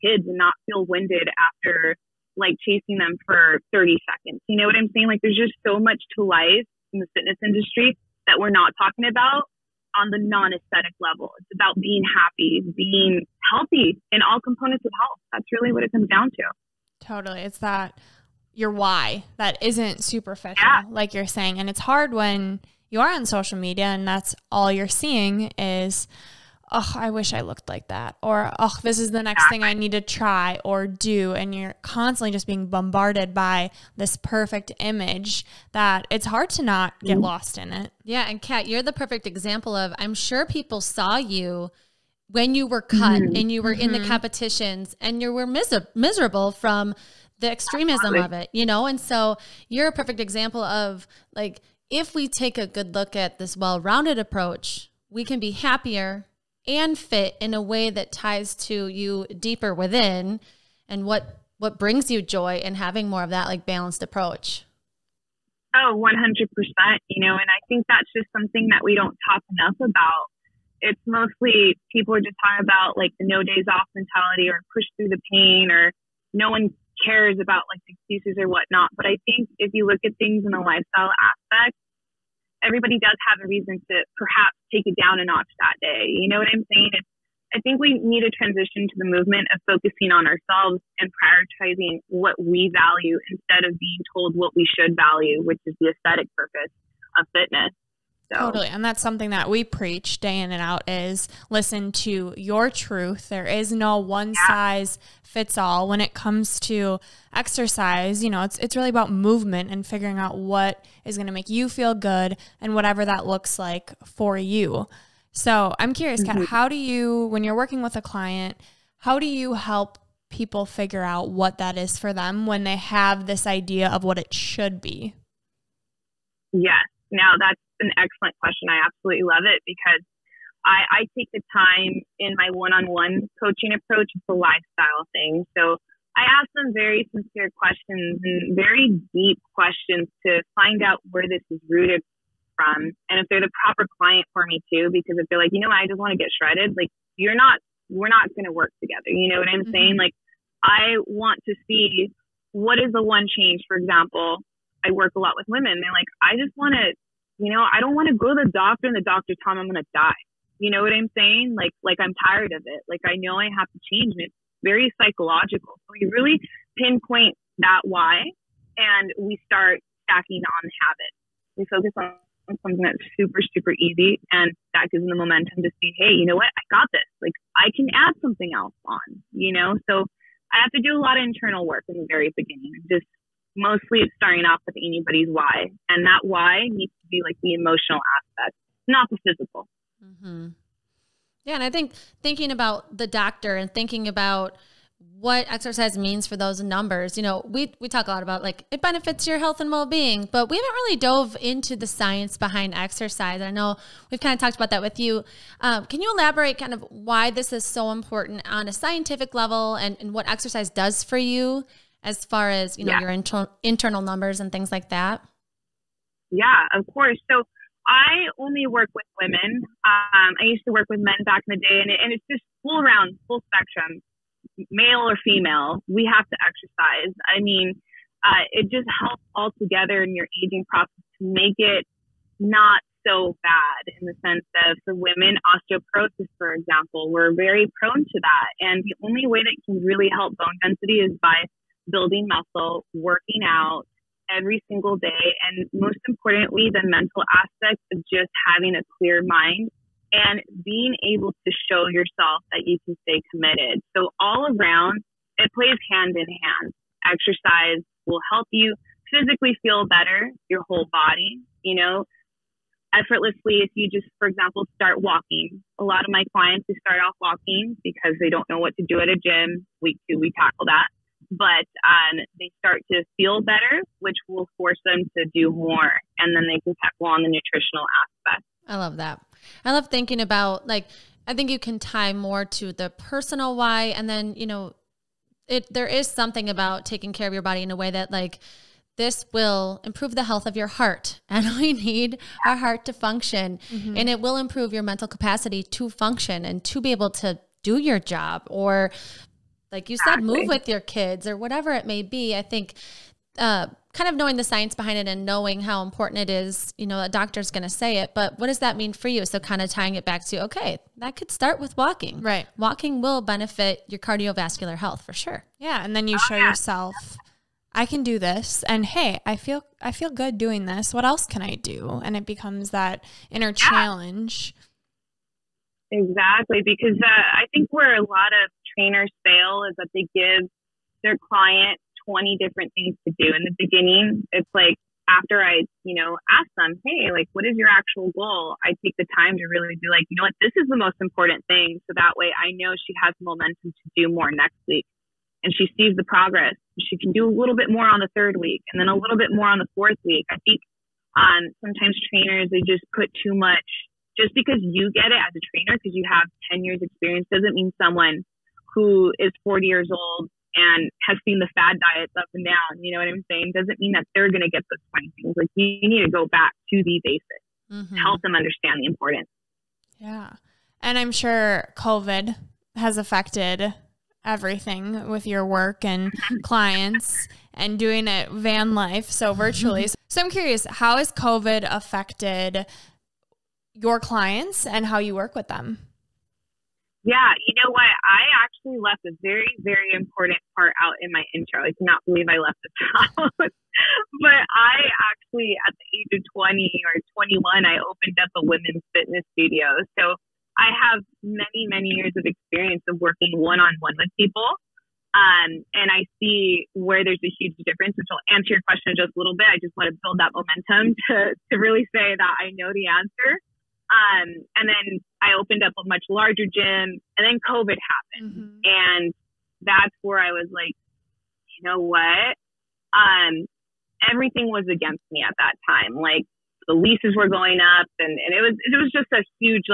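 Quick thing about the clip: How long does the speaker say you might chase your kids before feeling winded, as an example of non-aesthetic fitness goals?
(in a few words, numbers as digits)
30 seconds.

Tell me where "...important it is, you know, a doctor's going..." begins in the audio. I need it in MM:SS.
05:05.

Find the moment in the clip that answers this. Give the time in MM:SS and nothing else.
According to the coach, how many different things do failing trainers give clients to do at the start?
05:32.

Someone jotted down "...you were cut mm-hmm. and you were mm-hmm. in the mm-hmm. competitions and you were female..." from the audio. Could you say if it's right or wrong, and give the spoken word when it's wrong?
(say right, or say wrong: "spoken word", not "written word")
wrong: "miserable", not "female".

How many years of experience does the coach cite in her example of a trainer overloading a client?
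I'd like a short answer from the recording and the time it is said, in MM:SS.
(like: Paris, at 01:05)
10, at 05:56.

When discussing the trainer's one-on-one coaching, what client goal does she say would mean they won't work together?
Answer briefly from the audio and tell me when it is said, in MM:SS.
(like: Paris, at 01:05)
get shredded, at 02:26.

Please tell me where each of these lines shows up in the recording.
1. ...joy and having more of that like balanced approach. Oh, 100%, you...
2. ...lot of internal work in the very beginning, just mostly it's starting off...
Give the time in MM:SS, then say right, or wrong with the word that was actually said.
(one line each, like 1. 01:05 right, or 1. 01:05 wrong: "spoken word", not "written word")
1. 01:02 right
2. 03:01 right.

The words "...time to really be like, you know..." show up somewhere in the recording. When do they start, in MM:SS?
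05:39.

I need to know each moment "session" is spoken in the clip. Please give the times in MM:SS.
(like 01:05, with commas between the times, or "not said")
not said.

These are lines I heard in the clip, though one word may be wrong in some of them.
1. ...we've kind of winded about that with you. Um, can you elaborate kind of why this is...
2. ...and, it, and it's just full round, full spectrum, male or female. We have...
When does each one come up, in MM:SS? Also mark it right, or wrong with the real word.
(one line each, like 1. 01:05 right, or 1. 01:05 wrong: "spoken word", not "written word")
1. 03:24 wrong: "talked", not "winded"
2. 03:41 right.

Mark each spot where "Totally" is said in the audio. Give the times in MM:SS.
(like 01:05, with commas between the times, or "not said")
00:17, 01:38.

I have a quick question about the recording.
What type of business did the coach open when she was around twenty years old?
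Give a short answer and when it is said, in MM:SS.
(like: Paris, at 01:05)
women's fitness studio, at 06:38.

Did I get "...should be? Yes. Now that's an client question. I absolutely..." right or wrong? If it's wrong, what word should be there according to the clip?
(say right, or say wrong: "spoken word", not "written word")
wrong: "excellent", not "client".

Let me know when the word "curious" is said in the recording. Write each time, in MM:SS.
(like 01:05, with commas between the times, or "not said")
01:55, 06:20.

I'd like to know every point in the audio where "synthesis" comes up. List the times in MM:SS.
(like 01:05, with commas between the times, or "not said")
not said.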